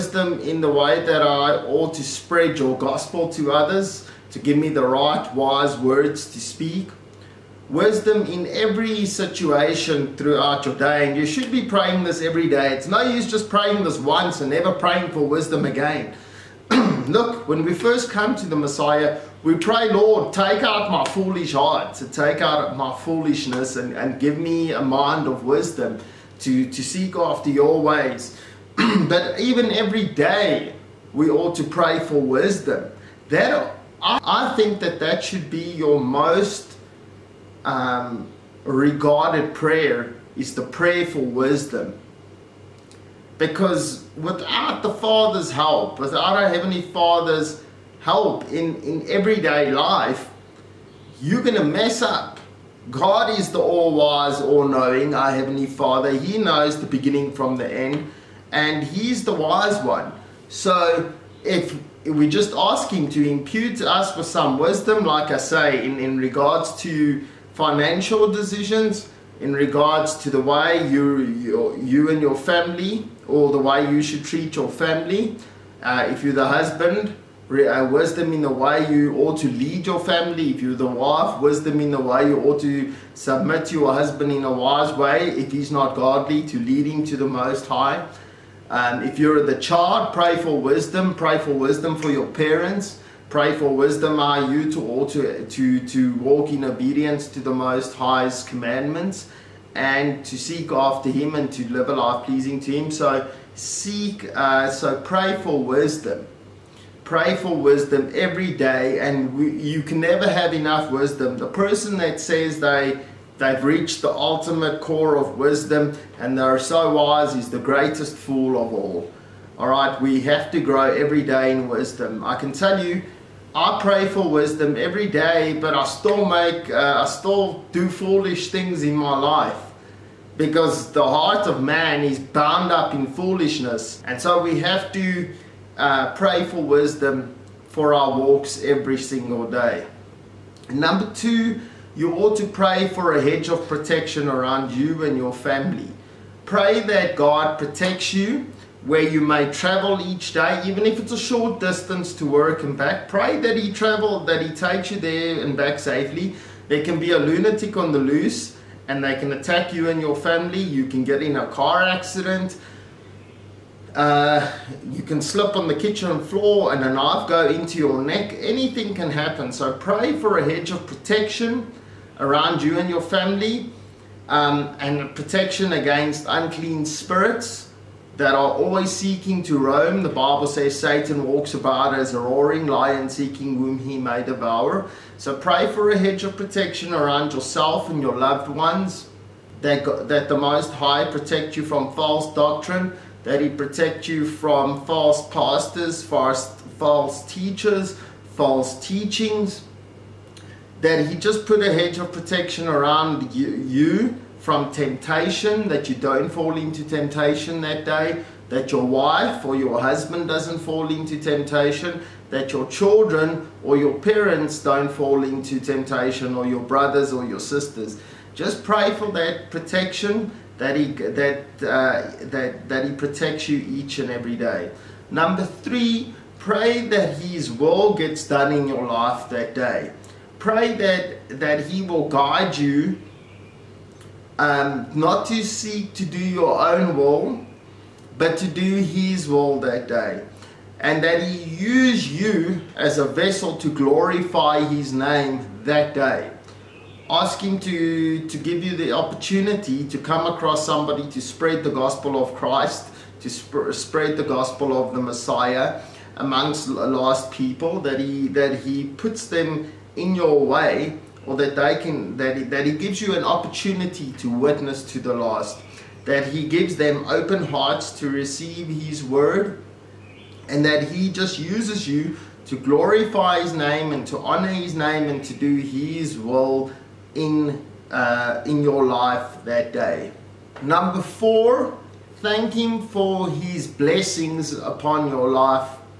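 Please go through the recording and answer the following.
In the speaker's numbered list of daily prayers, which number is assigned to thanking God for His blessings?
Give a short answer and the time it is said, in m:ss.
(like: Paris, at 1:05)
4, at 4:40.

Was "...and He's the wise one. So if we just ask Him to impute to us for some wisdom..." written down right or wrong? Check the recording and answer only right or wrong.
right.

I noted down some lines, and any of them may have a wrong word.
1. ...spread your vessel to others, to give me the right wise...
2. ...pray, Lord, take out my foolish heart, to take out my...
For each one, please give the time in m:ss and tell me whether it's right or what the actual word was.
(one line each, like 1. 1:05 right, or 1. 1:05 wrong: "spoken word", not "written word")
1. 0:02 wrong: "gospel", not "vessel"
2. 0:19 right.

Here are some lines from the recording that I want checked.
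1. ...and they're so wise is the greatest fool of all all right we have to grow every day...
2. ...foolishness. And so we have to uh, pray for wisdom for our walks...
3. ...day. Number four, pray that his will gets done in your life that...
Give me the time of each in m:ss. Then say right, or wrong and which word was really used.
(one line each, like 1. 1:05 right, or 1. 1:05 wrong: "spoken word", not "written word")
1. 1:56 right
2. 2:13 right
3. 3:44 wrong: "three", not "four".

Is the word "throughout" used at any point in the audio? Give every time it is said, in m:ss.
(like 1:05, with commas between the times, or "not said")
0:10.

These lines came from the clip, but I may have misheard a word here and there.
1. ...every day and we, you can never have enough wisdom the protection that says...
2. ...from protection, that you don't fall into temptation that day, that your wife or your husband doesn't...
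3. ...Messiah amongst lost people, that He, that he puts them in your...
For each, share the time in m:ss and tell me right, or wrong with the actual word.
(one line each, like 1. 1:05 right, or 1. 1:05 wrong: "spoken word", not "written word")
1. 1:48 wrong: "person", not "protection"
2. 3:24 wrong: "temptation", not "protection"
3. 4:15 right.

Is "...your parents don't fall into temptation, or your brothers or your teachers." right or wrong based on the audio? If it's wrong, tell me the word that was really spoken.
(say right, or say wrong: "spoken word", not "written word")
wrong: "sisters", not "teachers".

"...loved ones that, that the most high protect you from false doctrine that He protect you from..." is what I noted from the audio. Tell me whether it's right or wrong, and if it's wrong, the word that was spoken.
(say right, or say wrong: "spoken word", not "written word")
right.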